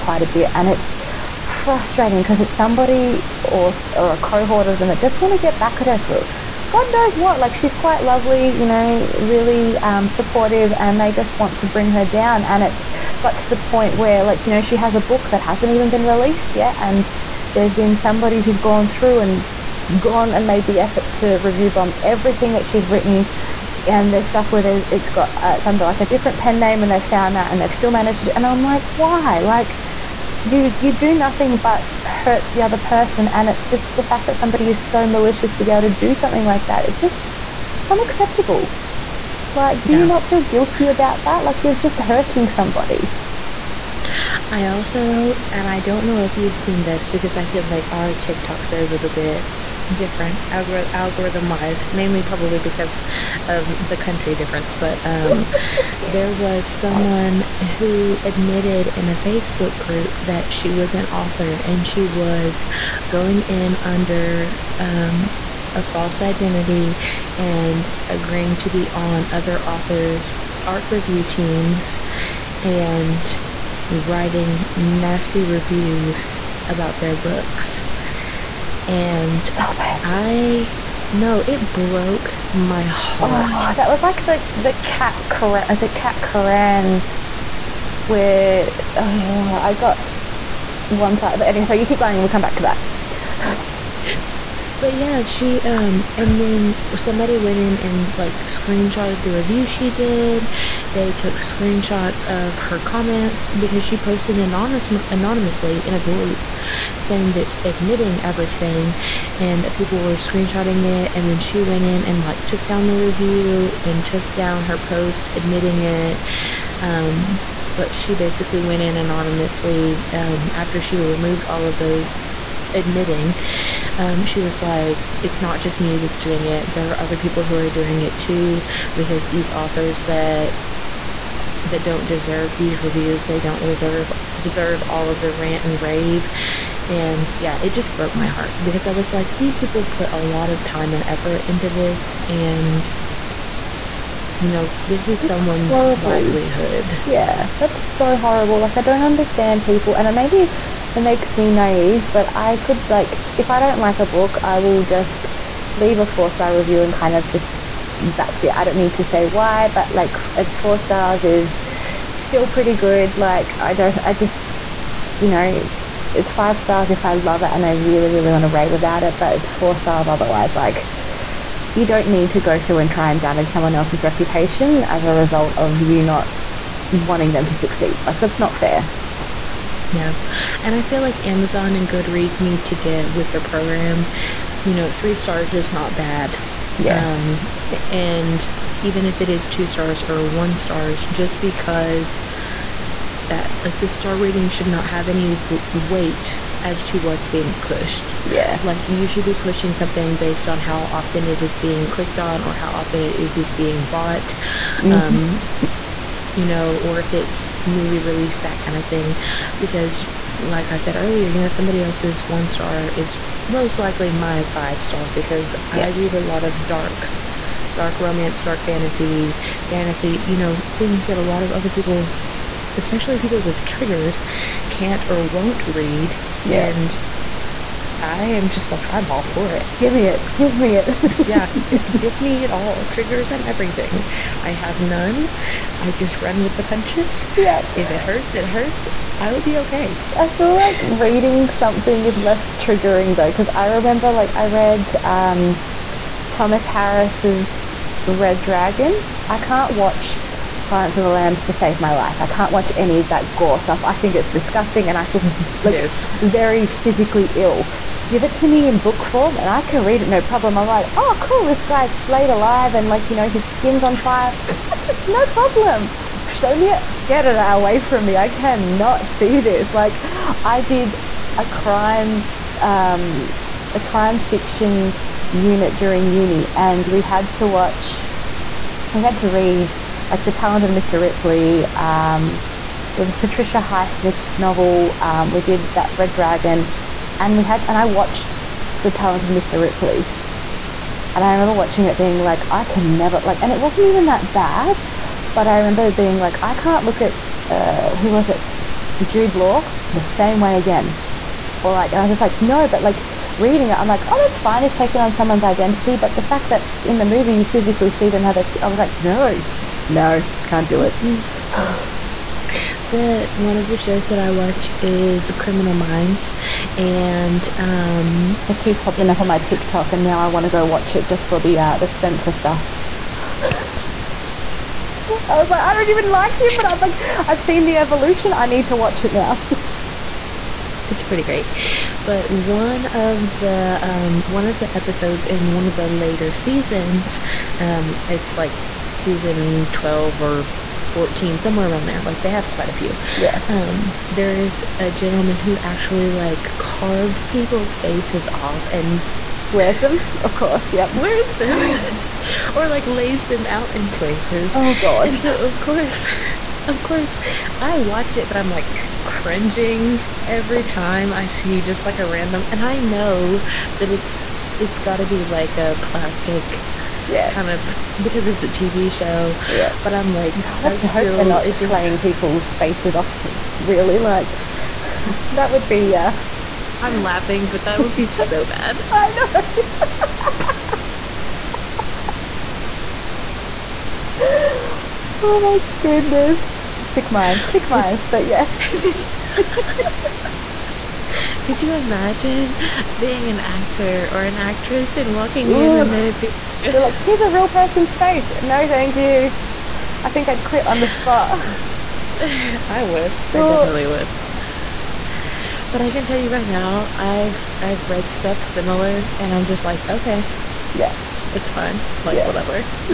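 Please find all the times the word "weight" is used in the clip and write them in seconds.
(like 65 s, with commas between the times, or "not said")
195 s.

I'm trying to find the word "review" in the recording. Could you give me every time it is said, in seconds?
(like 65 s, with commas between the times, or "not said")
21 s, 70 s, 75 s, 99 s, 112 s, 132 s, 156 s.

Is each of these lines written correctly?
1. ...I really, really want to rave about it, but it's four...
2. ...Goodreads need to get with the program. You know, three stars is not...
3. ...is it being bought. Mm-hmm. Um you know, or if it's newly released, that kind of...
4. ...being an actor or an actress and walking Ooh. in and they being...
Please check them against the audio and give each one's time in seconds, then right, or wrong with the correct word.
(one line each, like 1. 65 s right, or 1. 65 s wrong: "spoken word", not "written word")
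1. 167 s right
2. 181 s right
3. 203 s right
4. 392 s right.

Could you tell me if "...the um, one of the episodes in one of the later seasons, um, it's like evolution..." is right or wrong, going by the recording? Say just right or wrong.
wrong.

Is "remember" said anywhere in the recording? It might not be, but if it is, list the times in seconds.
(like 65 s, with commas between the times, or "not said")
243 s, 291 s, 295 s.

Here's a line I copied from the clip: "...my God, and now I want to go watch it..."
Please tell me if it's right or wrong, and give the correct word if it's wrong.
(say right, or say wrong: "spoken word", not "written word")
wrong: "TikTok", not "God".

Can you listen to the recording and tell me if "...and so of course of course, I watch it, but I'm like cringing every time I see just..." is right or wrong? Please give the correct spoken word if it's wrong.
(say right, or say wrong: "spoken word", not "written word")
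right.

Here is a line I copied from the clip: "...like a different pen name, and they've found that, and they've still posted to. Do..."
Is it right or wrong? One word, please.
wrong.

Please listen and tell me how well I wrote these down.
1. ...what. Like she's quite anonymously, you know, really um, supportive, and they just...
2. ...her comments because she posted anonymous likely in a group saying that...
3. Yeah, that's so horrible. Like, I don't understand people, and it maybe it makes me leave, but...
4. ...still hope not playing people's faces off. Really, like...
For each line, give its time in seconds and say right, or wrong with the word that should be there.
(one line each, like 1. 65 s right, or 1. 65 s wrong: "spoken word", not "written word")
1. 7 s wrong: "lovely", not "anonymously"
2. 102 s wrong: "anonymously", not "likely"
3. 147 s wrong: "naive", not "leave"
4. 370 s right.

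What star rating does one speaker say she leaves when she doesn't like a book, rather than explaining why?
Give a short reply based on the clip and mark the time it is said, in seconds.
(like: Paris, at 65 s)
4 stars, at 156 s.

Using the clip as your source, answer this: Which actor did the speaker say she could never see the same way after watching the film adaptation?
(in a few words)
Jude Law.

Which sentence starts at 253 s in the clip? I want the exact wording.
I think it's disgusting and I feel like yes.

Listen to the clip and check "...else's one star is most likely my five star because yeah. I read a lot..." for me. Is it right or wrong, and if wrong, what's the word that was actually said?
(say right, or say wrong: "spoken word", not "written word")
right.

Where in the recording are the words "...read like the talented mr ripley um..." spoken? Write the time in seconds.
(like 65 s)
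279 s.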